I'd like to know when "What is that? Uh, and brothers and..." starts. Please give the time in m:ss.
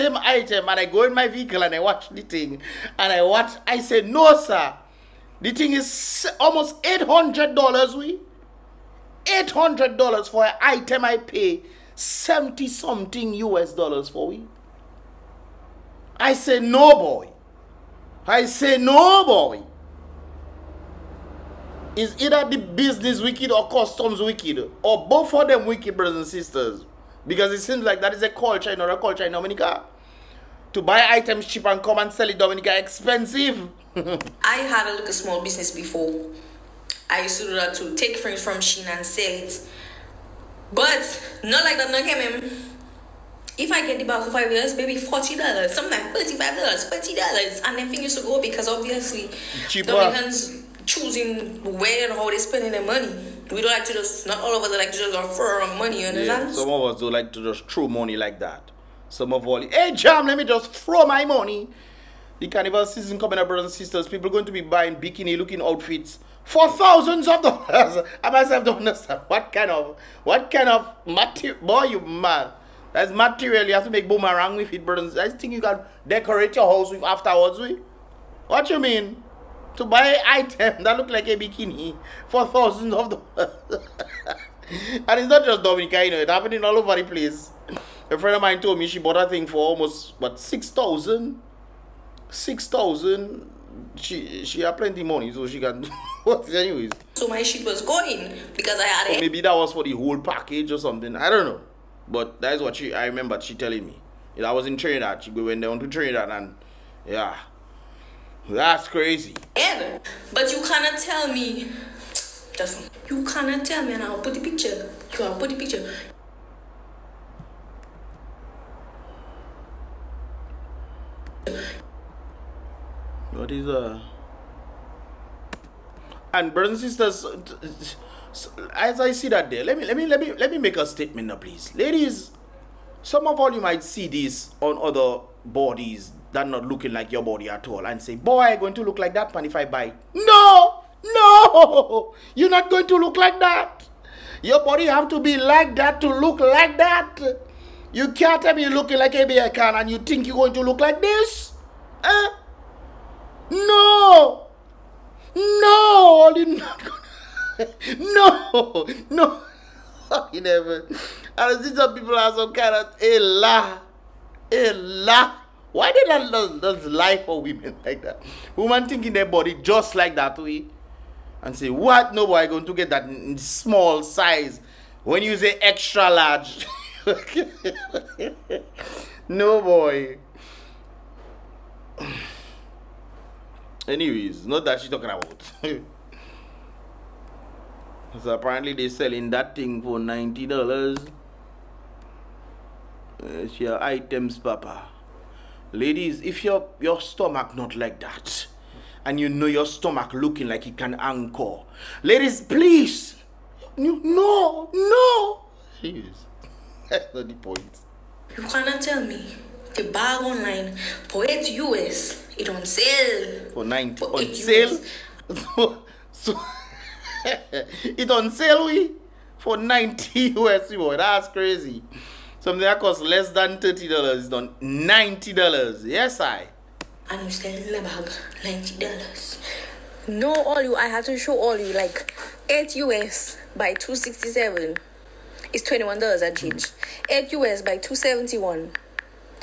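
2:03.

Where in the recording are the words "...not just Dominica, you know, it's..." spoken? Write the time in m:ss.
1:25.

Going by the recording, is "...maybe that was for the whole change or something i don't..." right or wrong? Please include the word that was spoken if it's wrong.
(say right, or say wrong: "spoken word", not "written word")
wrong: "package", not "change".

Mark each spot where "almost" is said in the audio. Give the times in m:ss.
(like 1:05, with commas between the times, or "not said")
0:06, 1:29.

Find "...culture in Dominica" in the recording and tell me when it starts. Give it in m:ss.
0:28.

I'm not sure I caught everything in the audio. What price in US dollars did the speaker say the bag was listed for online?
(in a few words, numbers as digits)
8 US.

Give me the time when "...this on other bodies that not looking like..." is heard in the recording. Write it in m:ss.
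2:14.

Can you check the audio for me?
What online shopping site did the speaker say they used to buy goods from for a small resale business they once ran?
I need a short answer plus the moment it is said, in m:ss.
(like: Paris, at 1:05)
Shein, at 0:38.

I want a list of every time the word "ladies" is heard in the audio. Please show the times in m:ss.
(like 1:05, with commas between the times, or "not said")
2:11, 3:15, 3:22.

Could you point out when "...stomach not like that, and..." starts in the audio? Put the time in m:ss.
3:17.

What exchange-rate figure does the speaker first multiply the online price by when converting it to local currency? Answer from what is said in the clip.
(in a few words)
2.67.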